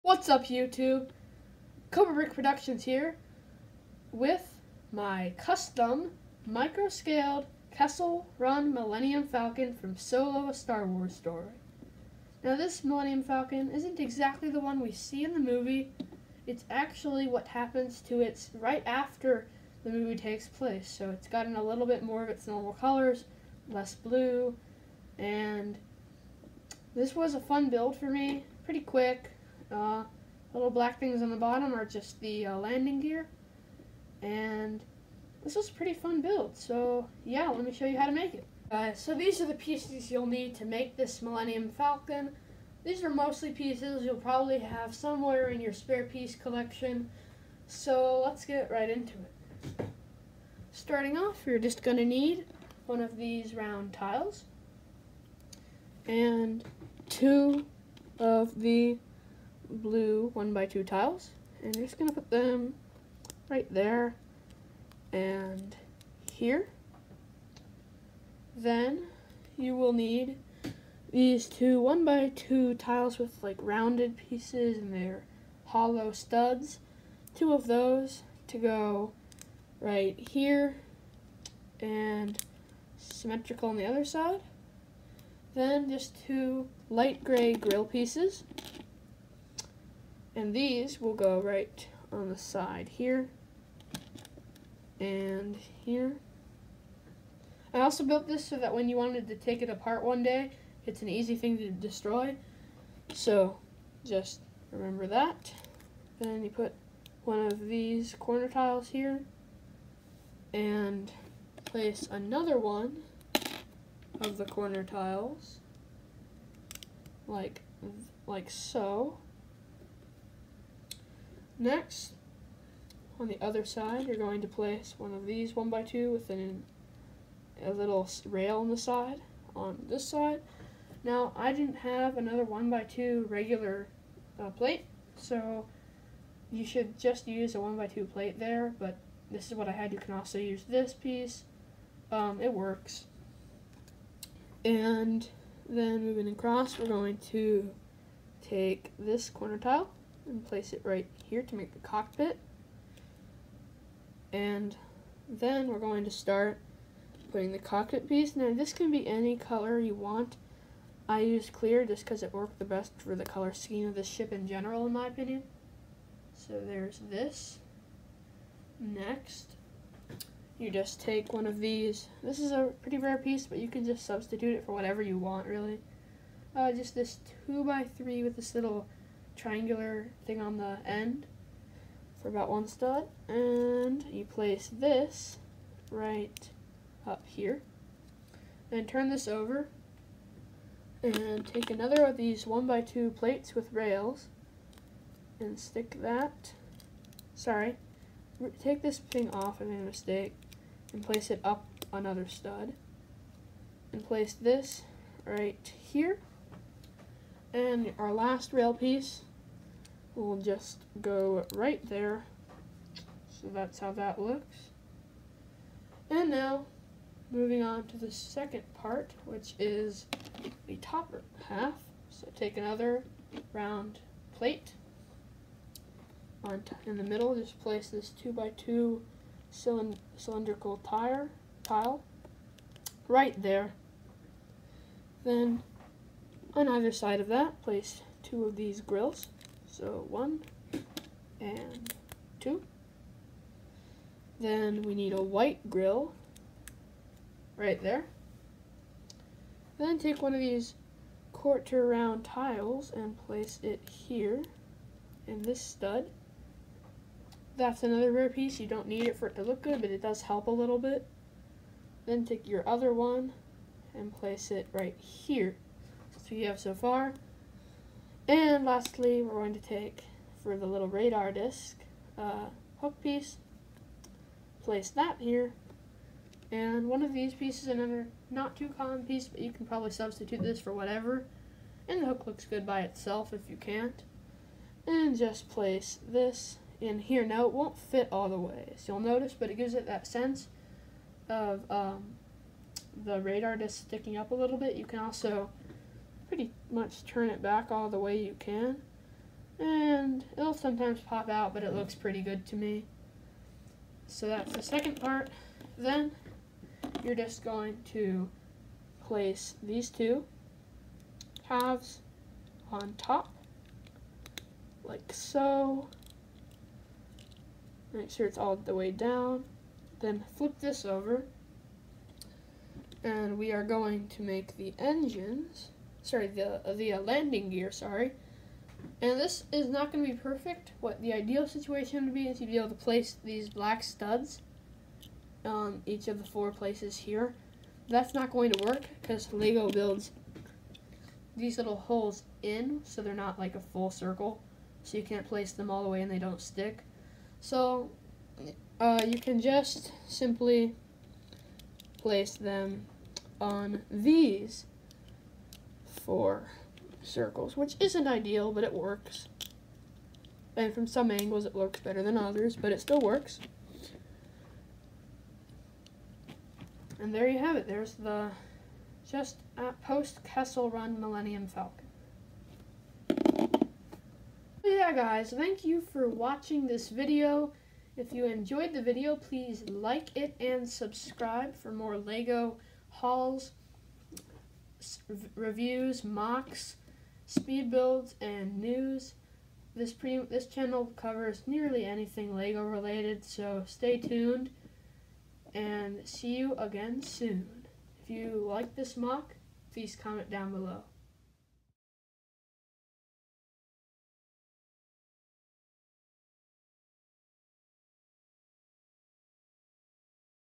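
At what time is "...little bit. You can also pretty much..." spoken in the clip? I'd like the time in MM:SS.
04:54.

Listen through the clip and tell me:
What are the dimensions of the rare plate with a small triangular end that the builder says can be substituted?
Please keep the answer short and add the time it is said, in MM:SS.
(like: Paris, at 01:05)
2 by 3, at 02:57.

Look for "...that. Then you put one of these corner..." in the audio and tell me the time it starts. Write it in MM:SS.
01:45.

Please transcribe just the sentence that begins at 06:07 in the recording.
There's the just post-Kessel Run Millennium Falcon.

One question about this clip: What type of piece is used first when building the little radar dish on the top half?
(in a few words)
Hook piece.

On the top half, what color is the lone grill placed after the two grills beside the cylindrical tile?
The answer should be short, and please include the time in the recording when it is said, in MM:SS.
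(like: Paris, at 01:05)
White, at 04:05.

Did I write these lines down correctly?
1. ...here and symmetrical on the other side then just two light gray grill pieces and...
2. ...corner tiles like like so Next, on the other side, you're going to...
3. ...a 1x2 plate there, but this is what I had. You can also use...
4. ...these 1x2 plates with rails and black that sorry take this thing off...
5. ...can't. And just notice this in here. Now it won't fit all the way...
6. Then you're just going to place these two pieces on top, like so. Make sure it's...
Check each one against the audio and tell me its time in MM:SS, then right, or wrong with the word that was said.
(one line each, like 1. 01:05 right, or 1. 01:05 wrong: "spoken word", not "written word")
1. 01:20 right
2. 01:54 right
3. 02:17 right
4. 03:12 wrong: "stick", not "black"
5. 04:43 wrong: "place", not "notice"
6. 05:05 wrong: "halves", not "pieces".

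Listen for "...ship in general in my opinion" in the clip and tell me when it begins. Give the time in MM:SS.
02:44.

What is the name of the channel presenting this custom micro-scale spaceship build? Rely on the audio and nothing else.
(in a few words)
Cobra Brick Productions.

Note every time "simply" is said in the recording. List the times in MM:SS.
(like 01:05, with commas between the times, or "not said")
05:50.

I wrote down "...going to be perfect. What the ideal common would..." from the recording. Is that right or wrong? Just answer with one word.
wrong.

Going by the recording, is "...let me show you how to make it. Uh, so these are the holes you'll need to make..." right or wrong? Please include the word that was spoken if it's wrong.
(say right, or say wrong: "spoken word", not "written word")
wrong: "pieces", not "holes".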